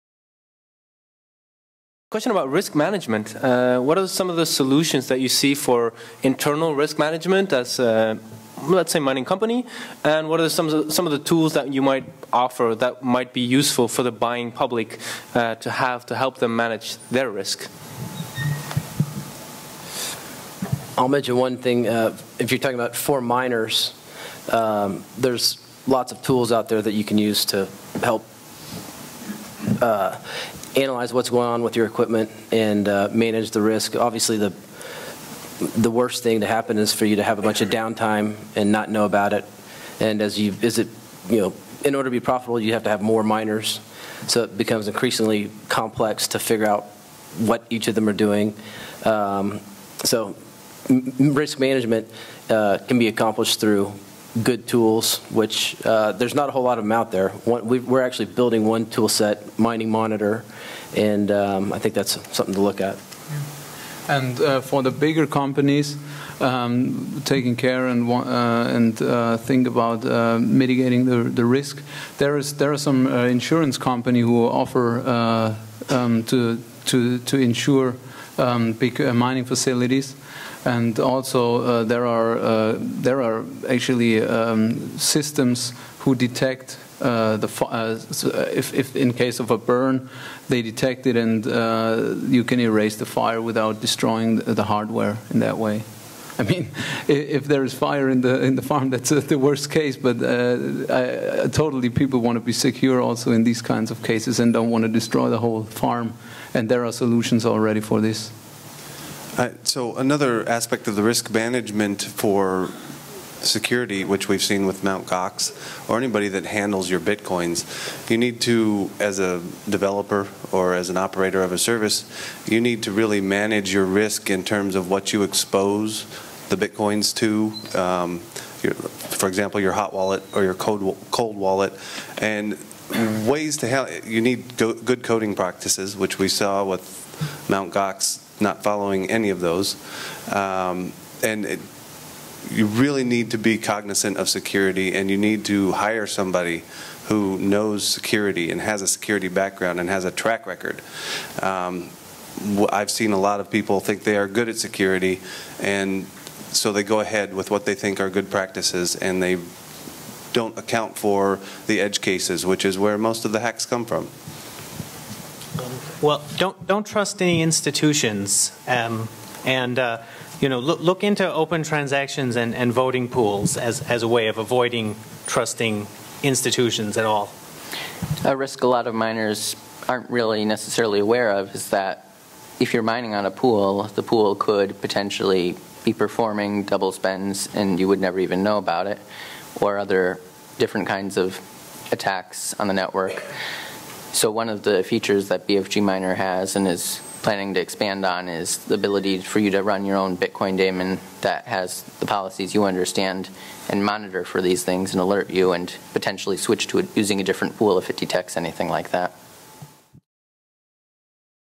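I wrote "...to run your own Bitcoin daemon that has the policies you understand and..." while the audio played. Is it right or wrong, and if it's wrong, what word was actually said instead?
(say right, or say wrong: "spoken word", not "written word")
right.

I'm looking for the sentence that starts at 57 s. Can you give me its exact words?
One, we, are actually building one tool set, Mining Monitor, and um, I think that's something to look at.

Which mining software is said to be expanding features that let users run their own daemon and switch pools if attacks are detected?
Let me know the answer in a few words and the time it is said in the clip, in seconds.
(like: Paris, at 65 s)
BFG Miner, at 195 s.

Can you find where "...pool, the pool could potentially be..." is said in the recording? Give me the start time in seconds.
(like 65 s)
183 s.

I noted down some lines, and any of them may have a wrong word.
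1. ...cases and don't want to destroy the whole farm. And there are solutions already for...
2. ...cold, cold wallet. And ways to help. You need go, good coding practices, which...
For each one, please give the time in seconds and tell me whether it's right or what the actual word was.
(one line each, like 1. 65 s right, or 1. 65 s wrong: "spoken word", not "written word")
1. 104 s right
2. 130 s right.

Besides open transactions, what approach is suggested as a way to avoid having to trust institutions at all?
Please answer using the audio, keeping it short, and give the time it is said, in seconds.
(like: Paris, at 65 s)
voting pools, at 172 s.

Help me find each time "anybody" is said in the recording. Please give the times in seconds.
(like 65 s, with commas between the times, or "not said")
115 s.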